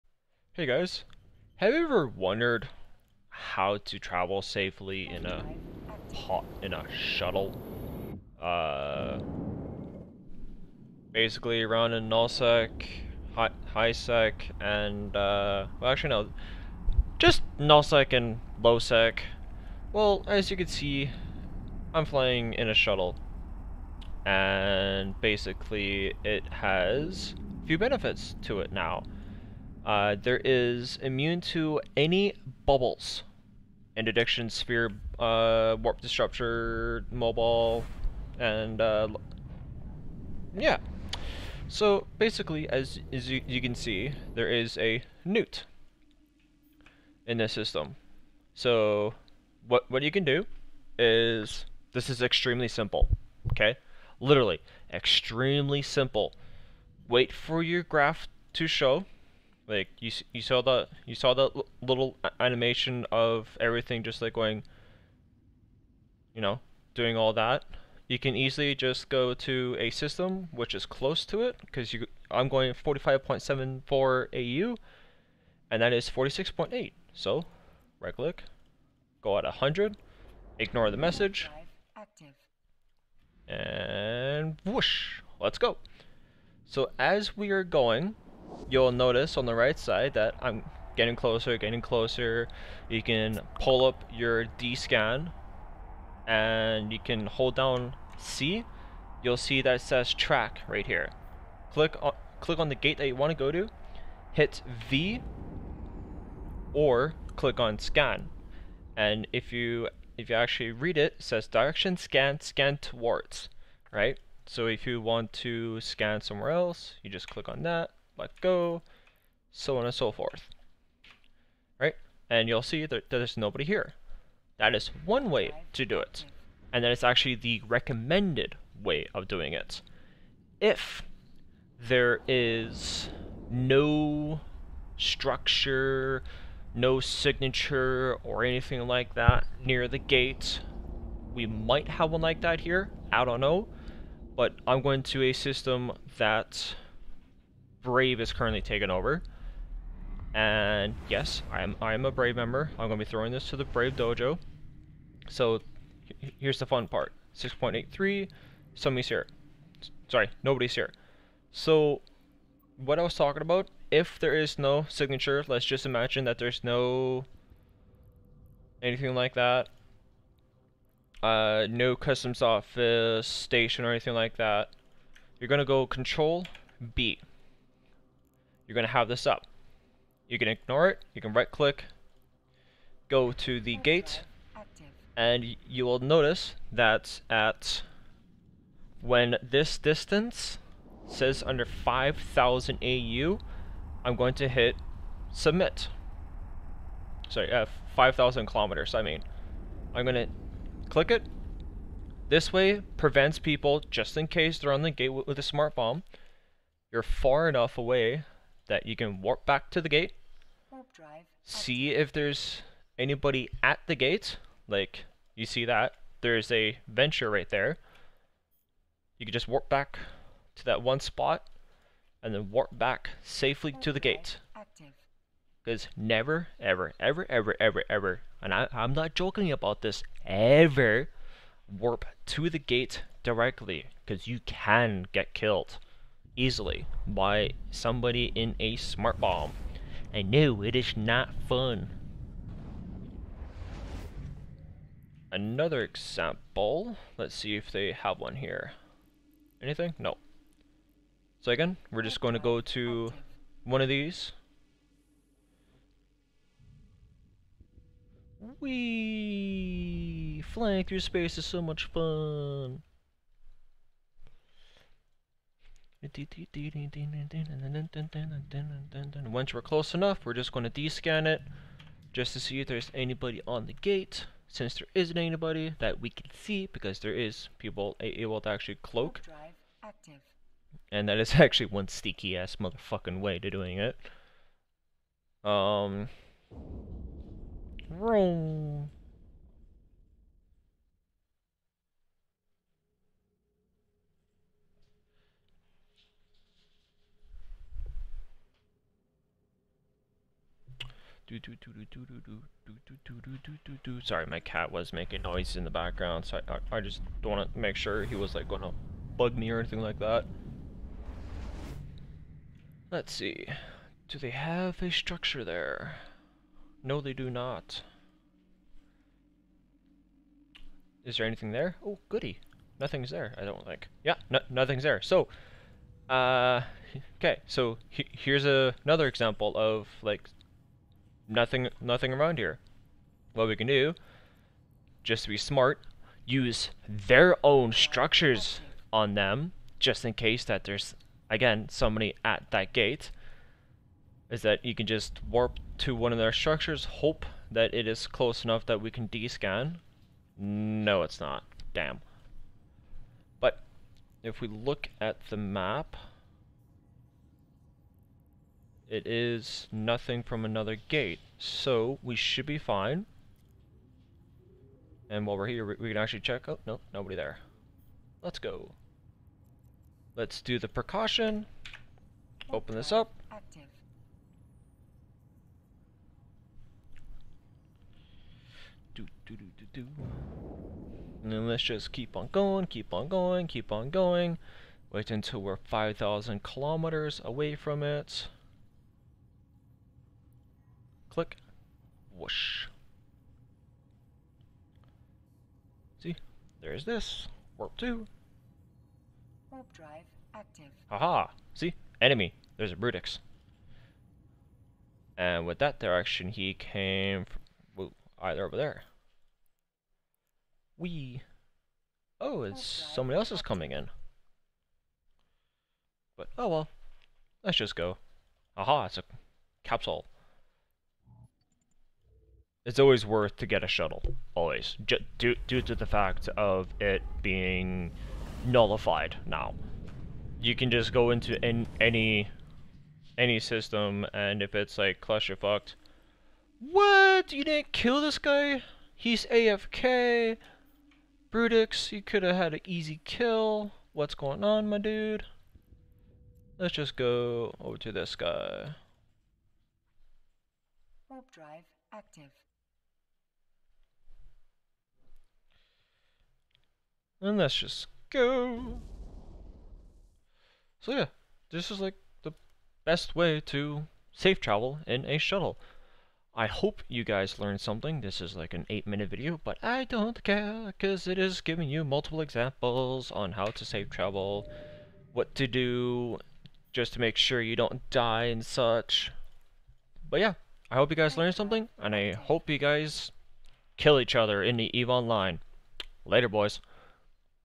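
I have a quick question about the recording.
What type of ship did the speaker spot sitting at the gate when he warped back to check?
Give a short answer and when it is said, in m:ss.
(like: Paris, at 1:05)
Venture, at 3:36.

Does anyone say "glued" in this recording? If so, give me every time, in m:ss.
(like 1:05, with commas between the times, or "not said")
not said.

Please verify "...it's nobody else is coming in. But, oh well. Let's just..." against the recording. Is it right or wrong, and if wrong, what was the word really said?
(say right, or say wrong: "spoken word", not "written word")
wrong: "somebody", not "nobody".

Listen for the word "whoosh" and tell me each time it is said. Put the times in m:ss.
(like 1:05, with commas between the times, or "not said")
1:24, 6:32.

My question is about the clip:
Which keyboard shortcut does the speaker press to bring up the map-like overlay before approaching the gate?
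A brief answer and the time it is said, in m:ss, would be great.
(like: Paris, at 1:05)
Control B, at 2:55.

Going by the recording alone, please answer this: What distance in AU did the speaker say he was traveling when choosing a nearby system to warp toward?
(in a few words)
45.74 AU.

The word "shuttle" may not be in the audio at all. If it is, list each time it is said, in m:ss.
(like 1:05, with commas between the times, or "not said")
0:06, 0:22, 7:03, 7:45.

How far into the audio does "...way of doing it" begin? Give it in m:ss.
2:08.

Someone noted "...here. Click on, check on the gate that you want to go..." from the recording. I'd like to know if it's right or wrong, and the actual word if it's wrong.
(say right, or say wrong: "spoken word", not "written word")
wrong: "click", not "check".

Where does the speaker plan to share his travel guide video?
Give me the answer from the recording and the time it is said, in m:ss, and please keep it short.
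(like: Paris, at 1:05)
Brave Dojo, at 2:33.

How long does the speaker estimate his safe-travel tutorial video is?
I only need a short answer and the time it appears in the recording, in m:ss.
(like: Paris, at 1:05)
8 minutes, at 7:48.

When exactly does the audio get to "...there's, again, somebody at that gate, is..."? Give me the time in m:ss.
5:40.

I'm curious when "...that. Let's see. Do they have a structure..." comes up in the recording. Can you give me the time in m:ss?
5:09.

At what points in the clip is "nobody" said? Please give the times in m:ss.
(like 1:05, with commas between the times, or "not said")
2:03, 2:40, 6:06.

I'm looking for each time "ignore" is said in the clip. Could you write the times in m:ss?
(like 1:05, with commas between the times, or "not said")
1:20, 3:00.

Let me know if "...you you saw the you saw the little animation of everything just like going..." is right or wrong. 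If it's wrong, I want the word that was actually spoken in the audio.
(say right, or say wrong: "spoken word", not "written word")
right.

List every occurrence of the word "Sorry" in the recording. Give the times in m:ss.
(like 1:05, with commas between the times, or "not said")
2:40, 3:17, 5:04.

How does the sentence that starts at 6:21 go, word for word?
And then let's just keep on going, keep on going, keep on going.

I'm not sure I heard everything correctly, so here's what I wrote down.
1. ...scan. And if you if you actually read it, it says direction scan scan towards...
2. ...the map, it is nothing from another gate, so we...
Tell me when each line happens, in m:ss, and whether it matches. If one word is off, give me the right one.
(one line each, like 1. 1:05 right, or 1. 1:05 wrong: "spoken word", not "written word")
1. 1:47 right
2. 5:55 right.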